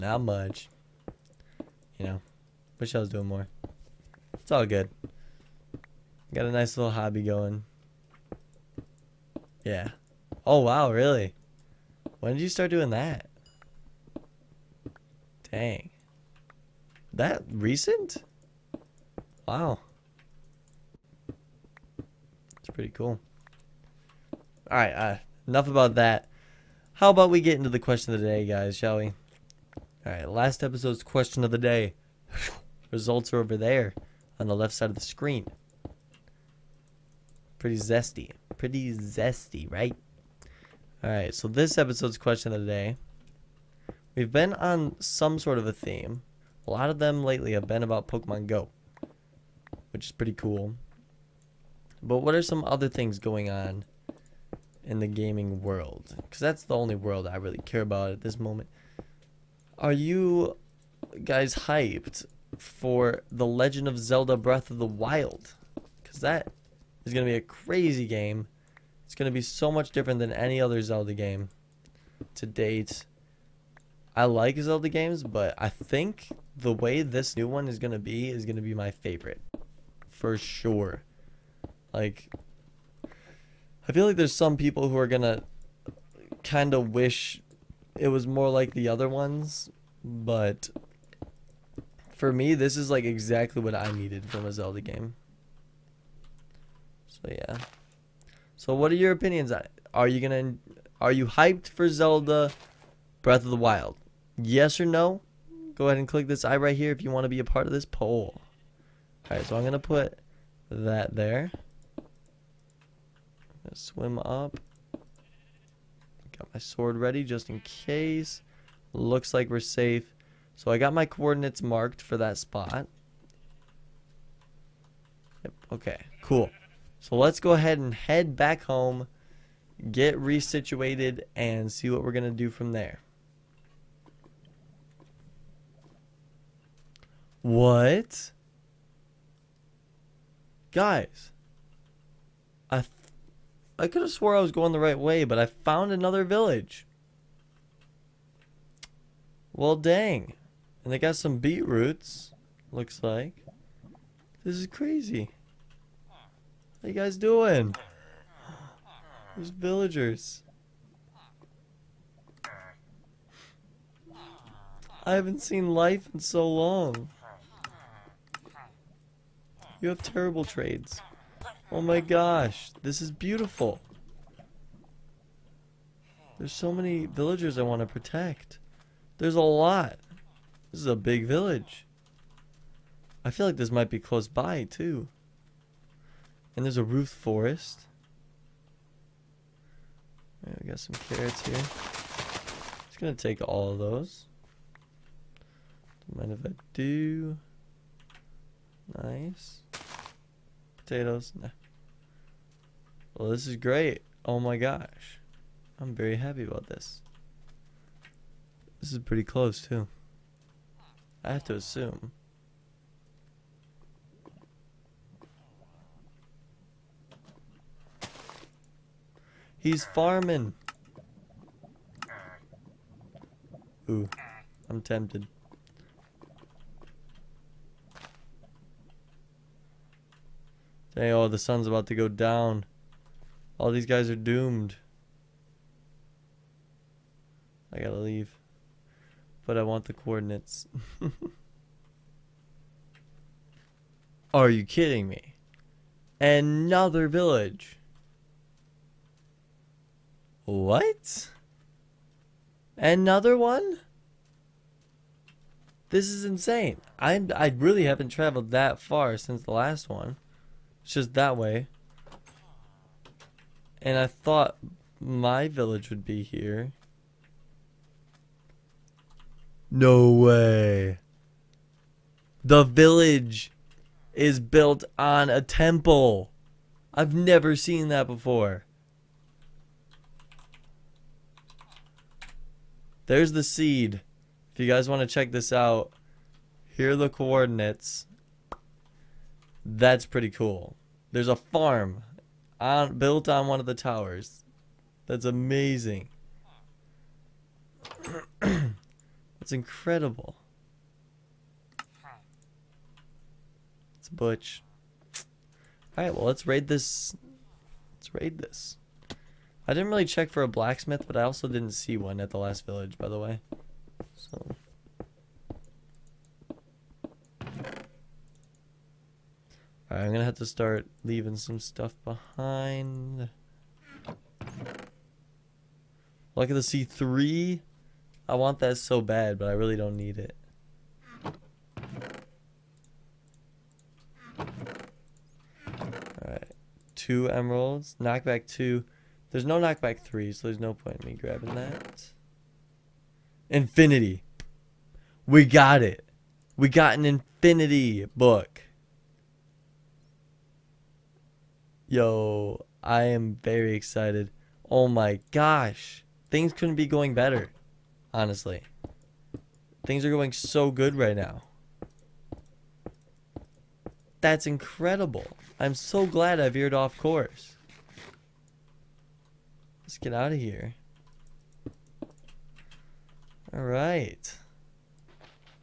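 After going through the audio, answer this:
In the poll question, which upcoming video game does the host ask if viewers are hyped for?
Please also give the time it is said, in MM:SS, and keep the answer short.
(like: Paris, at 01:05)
The Legend of Zelda Breath of the Wild, at 01:03.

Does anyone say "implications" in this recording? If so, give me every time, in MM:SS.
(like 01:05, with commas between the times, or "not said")
not said.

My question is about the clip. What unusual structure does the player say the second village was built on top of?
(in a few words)
A temple.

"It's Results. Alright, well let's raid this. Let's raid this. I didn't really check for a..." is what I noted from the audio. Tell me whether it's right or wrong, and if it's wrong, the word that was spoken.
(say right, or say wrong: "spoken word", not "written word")
wrong: "Butch", not "Results".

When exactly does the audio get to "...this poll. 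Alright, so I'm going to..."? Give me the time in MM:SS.
01:47.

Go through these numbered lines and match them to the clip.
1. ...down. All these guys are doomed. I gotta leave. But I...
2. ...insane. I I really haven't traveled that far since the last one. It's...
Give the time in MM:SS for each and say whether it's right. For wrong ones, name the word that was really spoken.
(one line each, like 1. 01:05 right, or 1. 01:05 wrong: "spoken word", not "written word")
1. 03:52 right
2. 04:16 right.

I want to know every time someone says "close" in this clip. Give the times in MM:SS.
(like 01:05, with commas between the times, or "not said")
03:03, 03:29.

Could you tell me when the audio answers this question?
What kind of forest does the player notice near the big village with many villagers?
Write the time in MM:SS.
03:06.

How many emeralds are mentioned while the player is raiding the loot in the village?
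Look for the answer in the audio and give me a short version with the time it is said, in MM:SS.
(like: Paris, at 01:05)
2, at 05:36.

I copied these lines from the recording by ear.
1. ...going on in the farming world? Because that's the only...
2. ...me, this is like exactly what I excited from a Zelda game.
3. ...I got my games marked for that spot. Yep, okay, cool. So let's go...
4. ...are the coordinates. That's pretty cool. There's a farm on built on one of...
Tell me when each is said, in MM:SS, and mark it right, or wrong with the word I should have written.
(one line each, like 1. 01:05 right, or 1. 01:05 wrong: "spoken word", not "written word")
1. 00:53 wrong: "gaming", not "farming"
2. 01:32 wrong: "needed", not "excited"
3. 02:00 wrong: "coordinates", not "games"
4. 04:46 right.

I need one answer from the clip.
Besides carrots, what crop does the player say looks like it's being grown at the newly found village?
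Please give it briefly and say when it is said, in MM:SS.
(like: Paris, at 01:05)
Beetroots, at 02:31.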